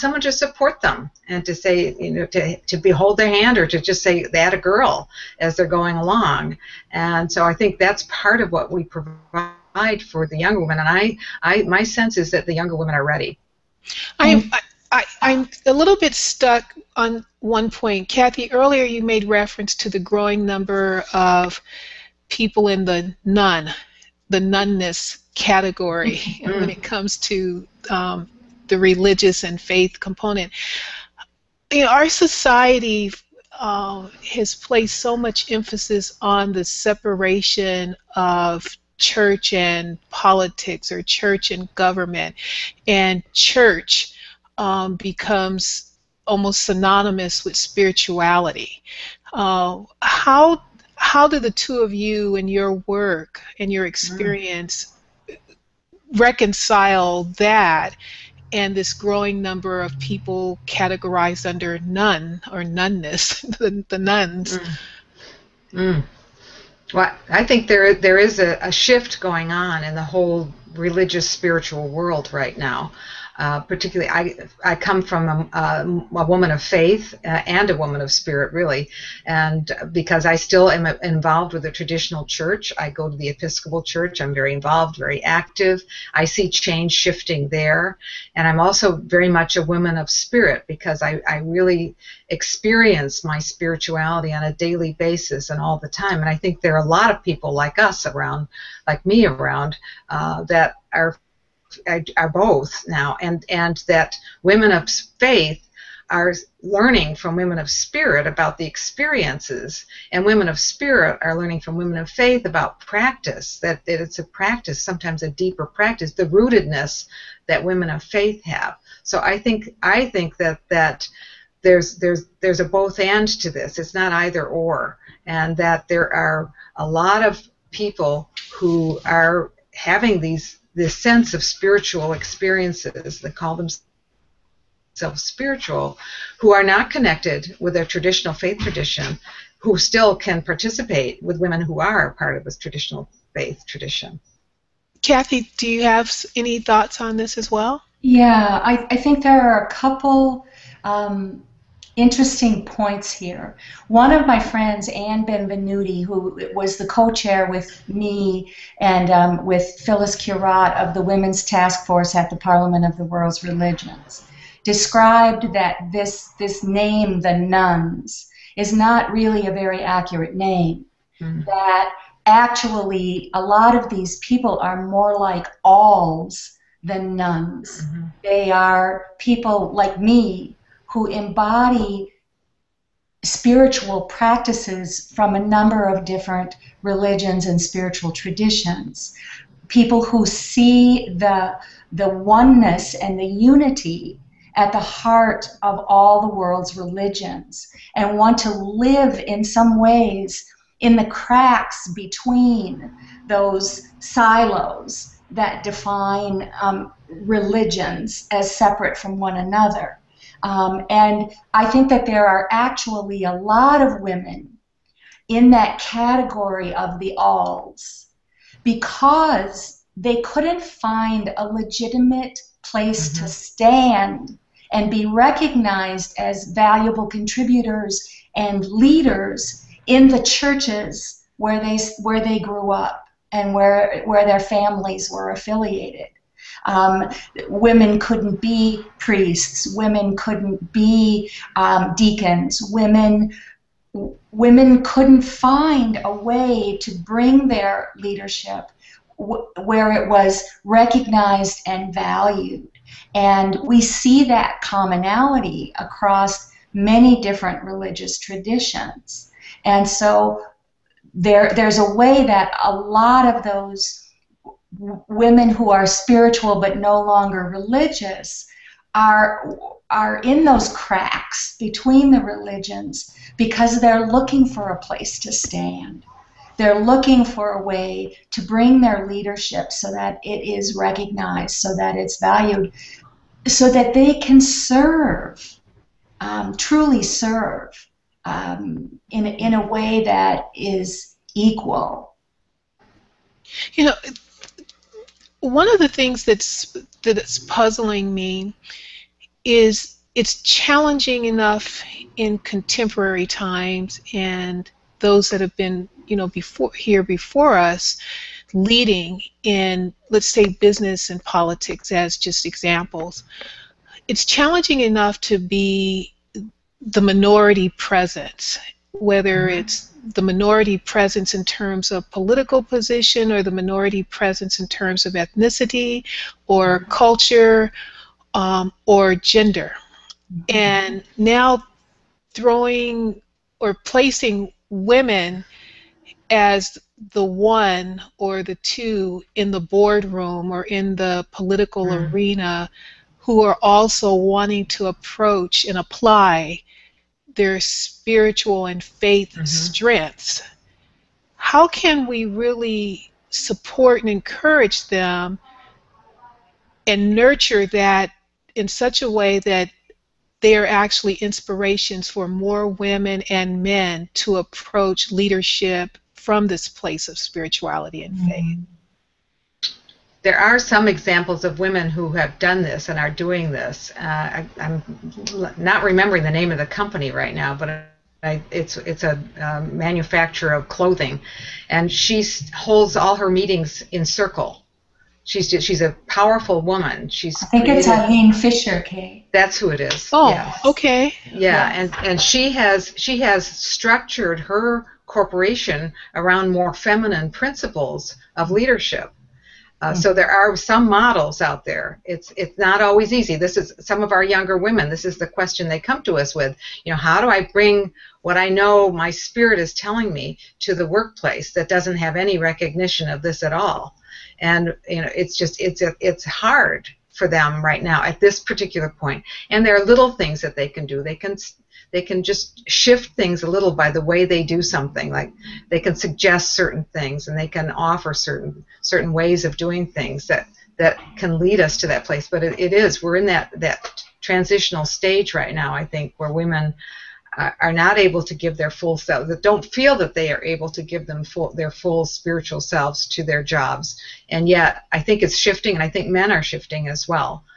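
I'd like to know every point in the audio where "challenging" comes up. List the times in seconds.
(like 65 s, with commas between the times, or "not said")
300 s, 314 s.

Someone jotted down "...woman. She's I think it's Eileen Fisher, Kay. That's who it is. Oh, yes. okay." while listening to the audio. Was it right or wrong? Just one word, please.
right.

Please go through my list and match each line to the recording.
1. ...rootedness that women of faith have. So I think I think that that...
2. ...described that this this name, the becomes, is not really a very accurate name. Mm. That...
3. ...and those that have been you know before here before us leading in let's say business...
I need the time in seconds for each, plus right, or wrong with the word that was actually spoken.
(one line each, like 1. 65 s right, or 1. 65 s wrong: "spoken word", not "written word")
1. 116 s right
2. 164 s wrong: "nones", not "becomes"
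3. 304 s right.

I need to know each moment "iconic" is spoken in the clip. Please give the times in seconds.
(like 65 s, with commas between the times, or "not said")
not said.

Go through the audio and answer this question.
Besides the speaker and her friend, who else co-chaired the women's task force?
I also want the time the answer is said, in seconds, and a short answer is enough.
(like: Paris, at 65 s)
Phyllis Curott, at 159 s.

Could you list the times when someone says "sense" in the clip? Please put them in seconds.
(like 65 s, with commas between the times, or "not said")
11 s, 130 s.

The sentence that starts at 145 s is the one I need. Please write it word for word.
Kathe, do you have any thoughts on this as well?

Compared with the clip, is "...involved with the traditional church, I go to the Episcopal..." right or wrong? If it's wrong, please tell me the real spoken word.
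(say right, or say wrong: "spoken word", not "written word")
right.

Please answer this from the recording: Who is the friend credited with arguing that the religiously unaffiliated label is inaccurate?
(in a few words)
Anne Benvenuti.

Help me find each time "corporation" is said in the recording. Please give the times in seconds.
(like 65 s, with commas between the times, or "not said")
395 s.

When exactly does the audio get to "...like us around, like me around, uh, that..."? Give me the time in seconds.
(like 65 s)
97 s.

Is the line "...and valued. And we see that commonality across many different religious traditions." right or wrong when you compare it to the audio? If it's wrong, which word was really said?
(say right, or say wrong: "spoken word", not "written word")
right.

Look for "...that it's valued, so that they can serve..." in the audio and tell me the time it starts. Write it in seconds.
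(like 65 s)
281 s.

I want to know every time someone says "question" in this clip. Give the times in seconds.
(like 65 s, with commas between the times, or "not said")
405 s.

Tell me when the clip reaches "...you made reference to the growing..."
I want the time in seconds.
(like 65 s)
18 s.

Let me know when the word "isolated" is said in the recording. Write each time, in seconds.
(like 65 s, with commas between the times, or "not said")
not said.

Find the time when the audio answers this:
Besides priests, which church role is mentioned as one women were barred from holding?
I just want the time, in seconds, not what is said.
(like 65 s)
241 s.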